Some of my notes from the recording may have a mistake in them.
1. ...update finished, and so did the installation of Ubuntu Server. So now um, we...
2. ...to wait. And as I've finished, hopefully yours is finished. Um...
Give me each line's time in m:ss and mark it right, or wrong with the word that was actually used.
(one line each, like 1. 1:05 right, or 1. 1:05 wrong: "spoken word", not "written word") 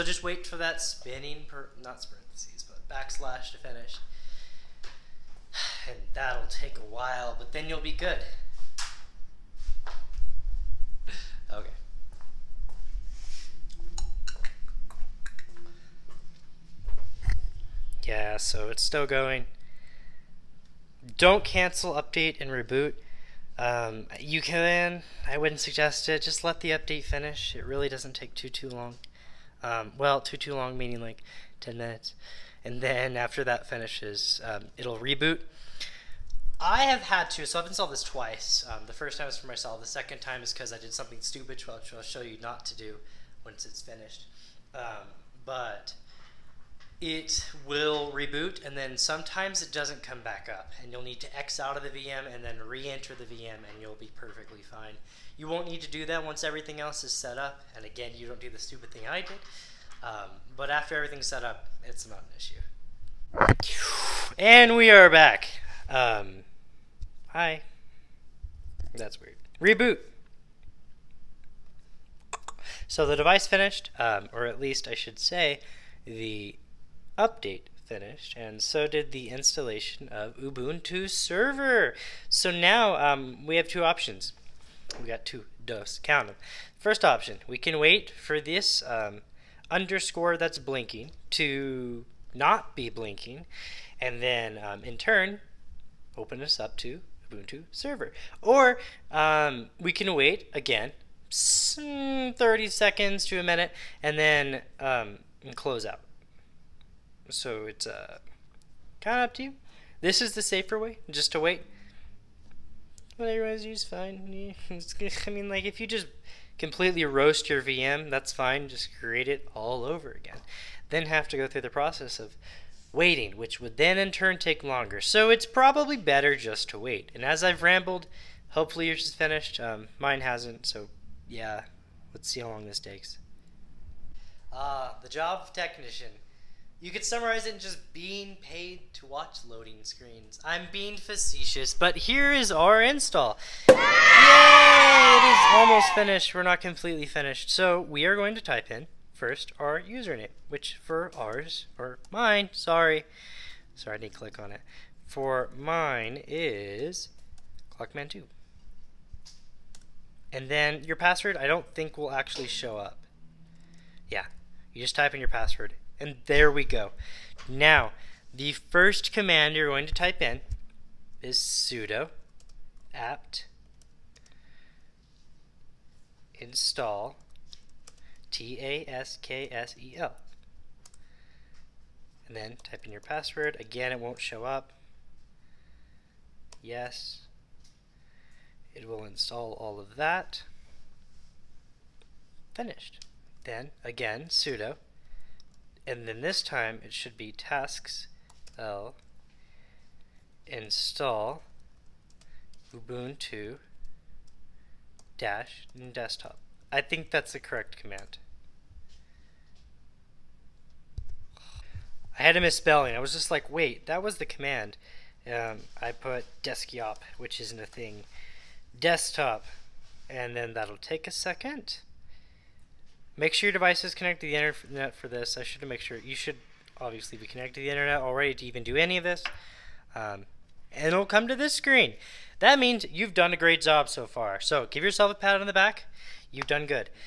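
1. 1:17 right
2. 2:06 wrong: "rambled", not "finished".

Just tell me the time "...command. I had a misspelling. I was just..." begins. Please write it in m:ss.
3:27.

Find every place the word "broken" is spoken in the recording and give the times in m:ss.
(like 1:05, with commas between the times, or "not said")
not said.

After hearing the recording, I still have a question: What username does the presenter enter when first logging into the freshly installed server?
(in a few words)
Clockman2.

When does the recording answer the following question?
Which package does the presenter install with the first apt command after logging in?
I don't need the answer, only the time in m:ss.
2:58.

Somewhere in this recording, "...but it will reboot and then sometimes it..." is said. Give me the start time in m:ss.
0:45.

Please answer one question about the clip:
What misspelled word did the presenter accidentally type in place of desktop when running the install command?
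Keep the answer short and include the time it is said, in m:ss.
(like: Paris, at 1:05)
deskyop, at 3:36.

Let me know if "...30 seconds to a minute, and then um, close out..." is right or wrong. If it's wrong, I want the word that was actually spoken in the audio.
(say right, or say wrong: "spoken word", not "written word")
right.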